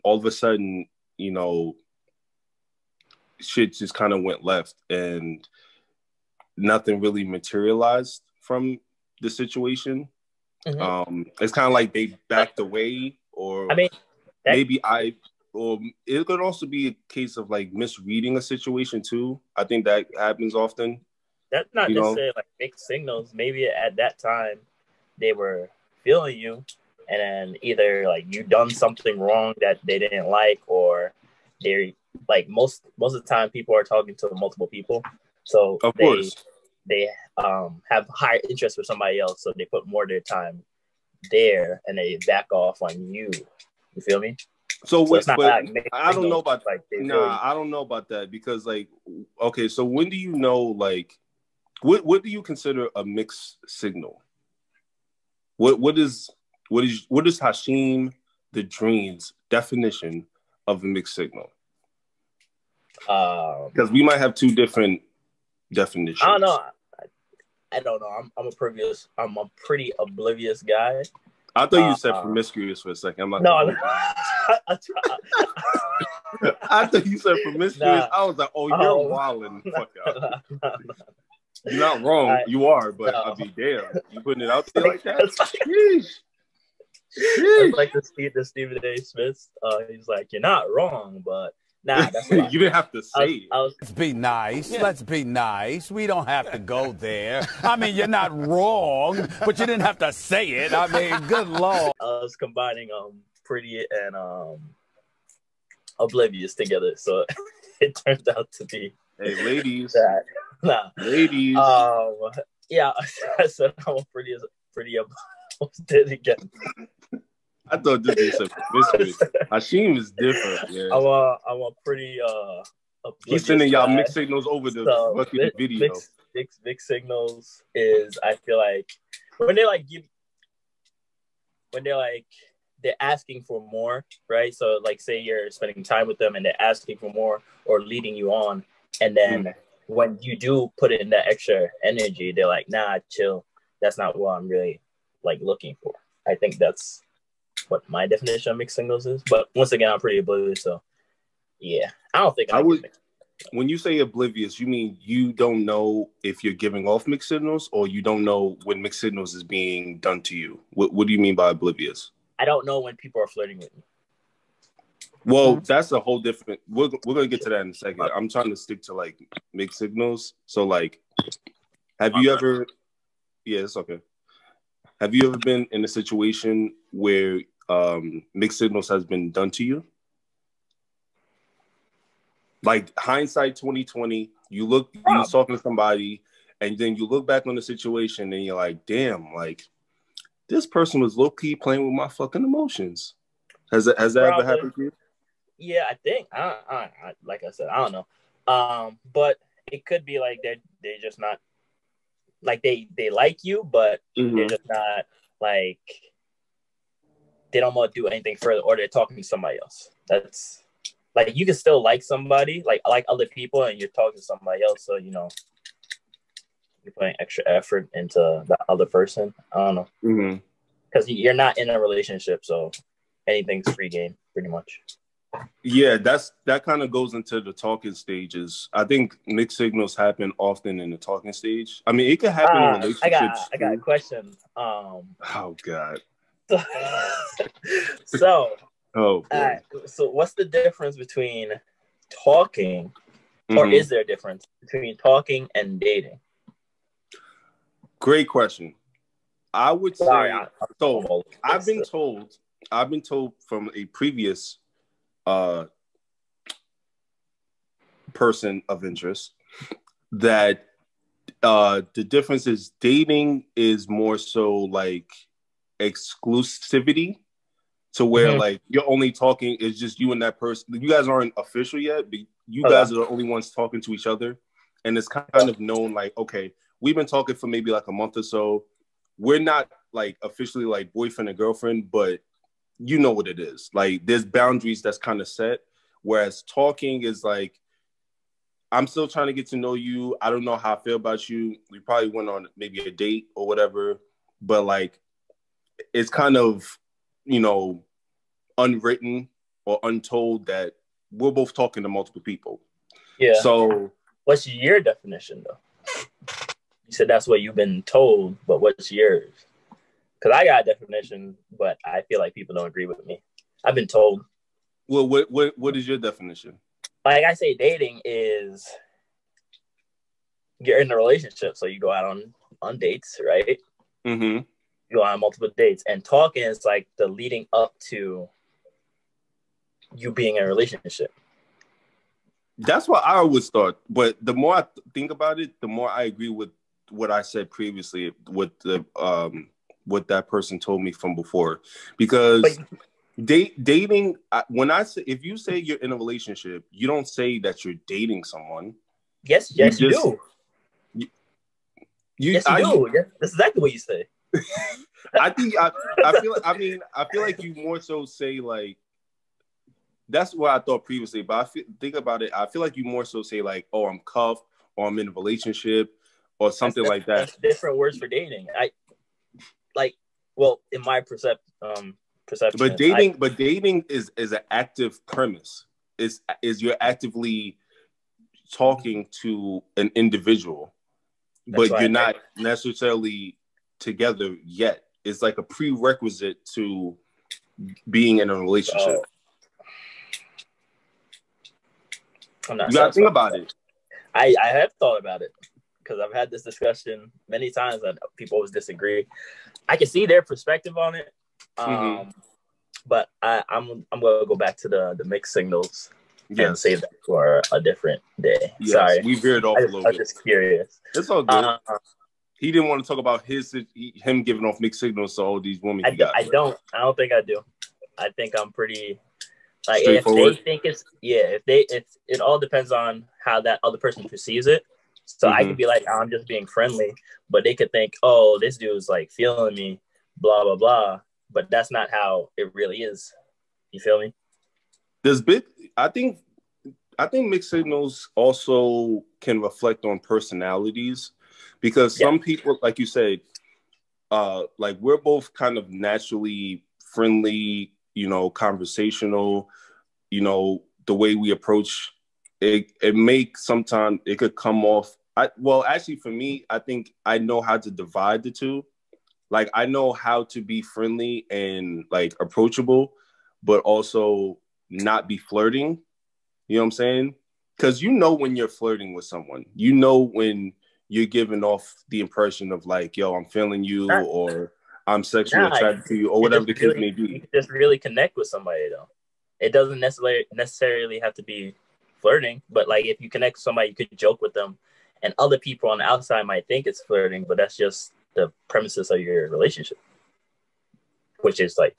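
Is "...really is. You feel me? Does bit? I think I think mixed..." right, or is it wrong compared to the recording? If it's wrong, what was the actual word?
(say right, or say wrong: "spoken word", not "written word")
right.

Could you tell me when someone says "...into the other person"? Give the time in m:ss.
3:37.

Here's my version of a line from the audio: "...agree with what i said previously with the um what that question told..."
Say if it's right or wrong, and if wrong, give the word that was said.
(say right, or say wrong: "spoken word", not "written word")
wrong: "person", not "question".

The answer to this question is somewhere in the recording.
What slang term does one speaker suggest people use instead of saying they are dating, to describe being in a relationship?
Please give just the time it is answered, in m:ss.
6:04.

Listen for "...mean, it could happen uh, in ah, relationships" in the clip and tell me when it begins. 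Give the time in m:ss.
3:51.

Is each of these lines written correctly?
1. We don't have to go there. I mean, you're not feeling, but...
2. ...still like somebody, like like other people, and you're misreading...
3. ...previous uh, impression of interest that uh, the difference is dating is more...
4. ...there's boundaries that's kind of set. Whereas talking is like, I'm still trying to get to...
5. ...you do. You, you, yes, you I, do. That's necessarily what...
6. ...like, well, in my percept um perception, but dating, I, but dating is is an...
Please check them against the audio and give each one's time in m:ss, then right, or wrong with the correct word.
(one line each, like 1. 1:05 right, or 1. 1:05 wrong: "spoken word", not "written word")
1. 1:35 wrong: "wrong", not "feeling"
2. 3:31 wrong: "talking", not "misreading"
3. 4:13 wrong: "person", not "impression"
4. 4:44 right
5. 5:50 wrong: "exactly", not "necessarily"
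6. 6:09 right.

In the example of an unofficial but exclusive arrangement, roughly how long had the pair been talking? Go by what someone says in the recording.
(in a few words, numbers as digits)
a month.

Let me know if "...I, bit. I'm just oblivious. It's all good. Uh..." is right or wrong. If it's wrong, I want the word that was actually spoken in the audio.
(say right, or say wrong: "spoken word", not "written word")
wrong: "curious", not "oblivious".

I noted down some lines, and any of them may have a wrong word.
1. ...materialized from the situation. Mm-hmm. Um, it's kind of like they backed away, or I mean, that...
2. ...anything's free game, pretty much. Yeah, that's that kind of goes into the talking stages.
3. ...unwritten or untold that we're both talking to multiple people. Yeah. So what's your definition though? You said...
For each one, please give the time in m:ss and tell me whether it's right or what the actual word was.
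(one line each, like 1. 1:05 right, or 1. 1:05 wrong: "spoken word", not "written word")
1. 0:07 right
2. 3:43 right
3. 4:58 right.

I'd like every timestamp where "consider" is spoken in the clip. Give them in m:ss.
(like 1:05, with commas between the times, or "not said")
0:52.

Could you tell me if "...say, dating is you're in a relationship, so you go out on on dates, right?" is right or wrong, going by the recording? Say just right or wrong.
right.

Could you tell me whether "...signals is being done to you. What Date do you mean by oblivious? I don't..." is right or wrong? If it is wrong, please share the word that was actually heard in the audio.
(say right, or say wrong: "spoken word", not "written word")
wrong: "What", not "Date".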